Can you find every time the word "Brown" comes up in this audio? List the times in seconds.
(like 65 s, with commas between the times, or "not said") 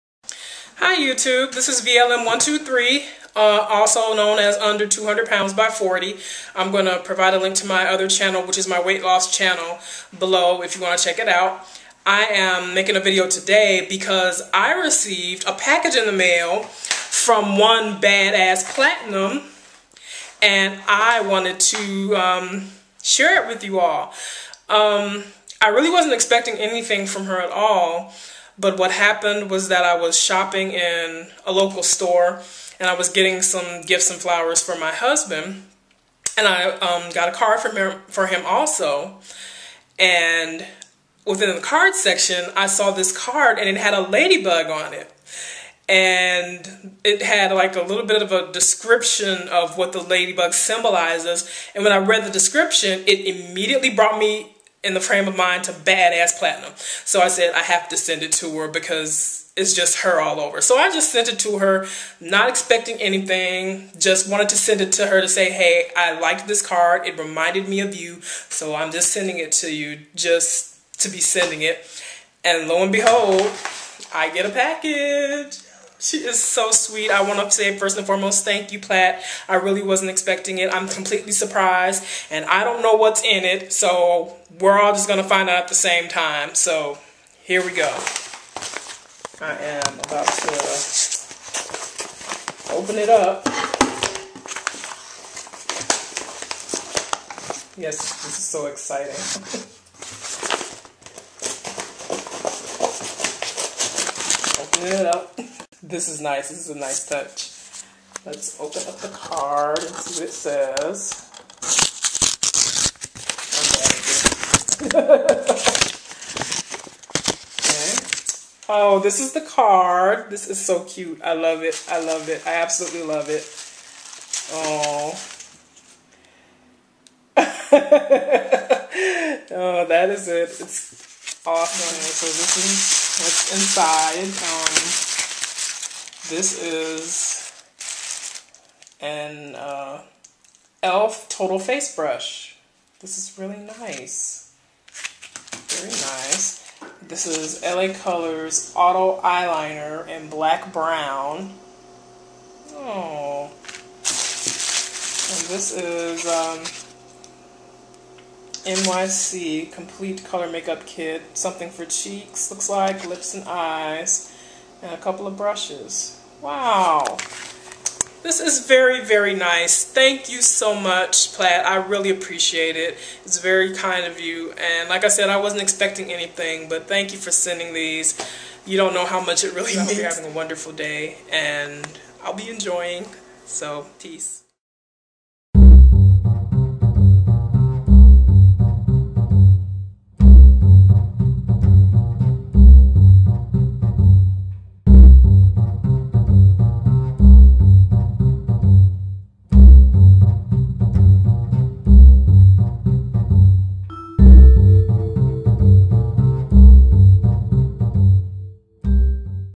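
150 s.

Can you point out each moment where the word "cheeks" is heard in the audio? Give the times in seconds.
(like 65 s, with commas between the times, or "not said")
161 s.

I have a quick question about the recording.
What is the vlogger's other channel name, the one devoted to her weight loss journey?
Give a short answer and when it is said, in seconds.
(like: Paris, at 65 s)
Under 200 Pounds by 40, at 4 s.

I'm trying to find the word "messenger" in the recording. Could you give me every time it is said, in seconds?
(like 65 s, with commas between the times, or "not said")
not said.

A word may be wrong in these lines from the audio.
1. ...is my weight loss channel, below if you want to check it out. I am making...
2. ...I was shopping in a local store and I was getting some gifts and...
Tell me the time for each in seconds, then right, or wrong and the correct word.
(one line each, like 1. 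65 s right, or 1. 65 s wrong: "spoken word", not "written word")
1. 8 s right
2. 29 s right.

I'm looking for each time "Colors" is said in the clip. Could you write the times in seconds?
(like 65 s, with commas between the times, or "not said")
148 s, 160 s.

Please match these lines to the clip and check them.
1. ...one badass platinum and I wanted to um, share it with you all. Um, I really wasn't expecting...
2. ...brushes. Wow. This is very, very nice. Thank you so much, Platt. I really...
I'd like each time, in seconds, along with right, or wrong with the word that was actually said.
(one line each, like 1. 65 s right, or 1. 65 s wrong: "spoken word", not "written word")
1. 17 s right
2. 165 s right.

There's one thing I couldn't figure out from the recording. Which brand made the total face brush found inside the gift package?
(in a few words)
e.l.f.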